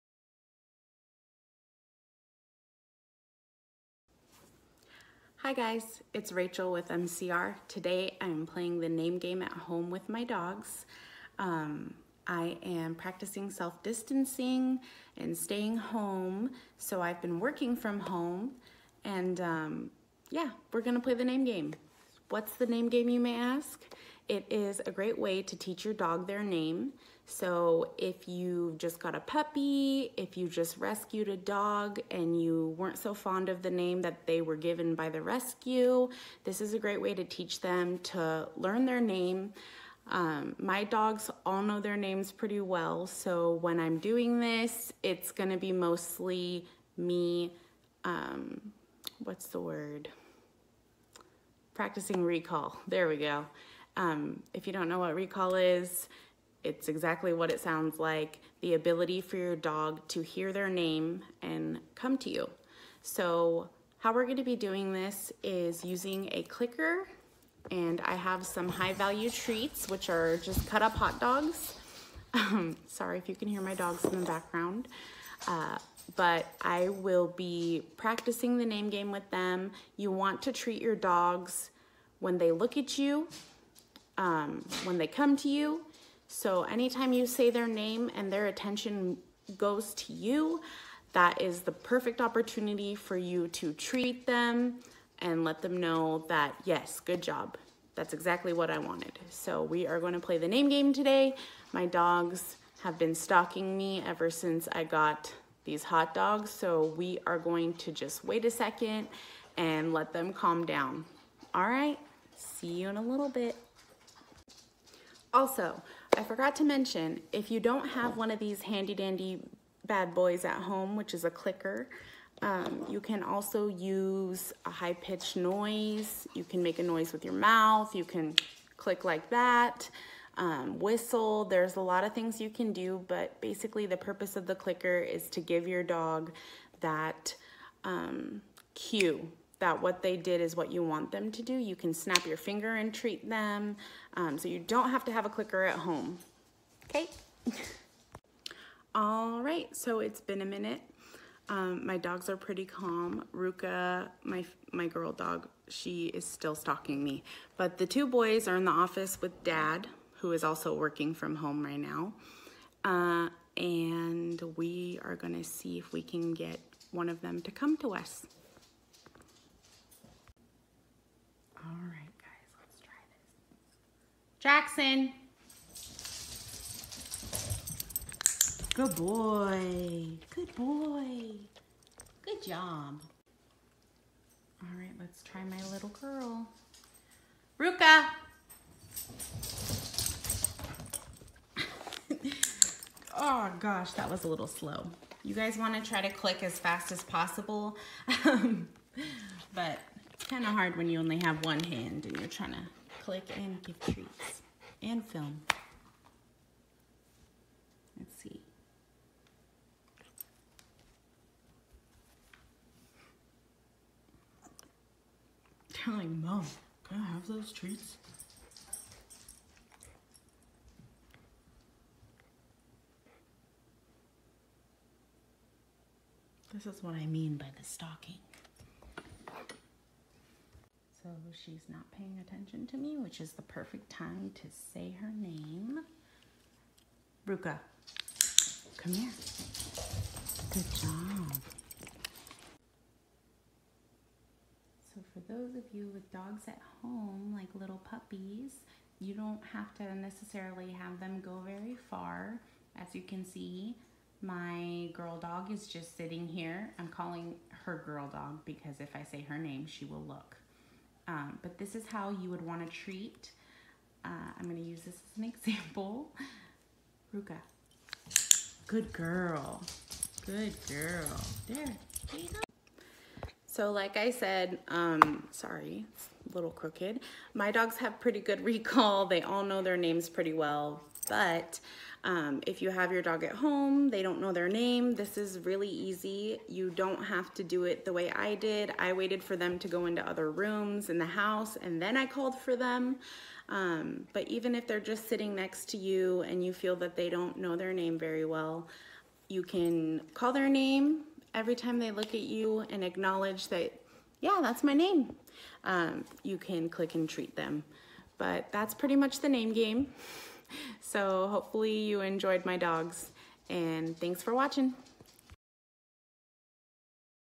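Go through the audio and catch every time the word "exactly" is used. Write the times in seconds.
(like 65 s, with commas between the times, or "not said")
56 s, 98 s.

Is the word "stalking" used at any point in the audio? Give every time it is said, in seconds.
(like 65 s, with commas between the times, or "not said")
103 s, 156 s, 227 s.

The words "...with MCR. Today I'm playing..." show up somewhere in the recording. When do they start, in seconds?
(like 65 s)
6 s.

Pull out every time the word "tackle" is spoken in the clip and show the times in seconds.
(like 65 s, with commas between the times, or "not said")
not said.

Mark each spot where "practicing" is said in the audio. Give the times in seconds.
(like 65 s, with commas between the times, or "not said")
12 s, 51 s, 77 s.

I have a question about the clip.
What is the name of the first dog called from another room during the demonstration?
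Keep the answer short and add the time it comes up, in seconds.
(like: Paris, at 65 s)
Jackson, at 174 s.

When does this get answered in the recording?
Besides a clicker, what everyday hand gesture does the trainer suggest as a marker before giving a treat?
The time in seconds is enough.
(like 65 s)
141 s.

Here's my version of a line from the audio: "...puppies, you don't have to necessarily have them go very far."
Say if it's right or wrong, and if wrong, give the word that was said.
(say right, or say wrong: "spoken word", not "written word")
right.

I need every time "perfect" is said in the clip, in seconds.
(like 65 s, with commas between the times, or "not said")
91 s, 233 s.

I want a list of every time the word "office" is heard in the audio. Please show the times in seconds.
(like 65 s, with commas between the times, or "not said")
158 s.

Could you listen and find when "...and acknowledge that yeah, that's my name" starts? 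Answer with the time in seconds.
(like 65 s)
302 s.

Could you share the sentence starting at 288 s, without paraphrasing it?
I waited for them to go into other rooms in the house and then I called for them.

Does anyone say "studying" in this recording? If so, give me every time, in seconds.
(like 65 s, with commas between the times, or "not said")
not said.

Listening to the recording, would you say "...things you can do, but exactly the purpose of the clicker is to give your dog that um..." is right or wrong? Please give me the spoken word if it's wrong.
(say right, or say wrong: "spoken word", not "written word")
wrong: "basically", not "exactly".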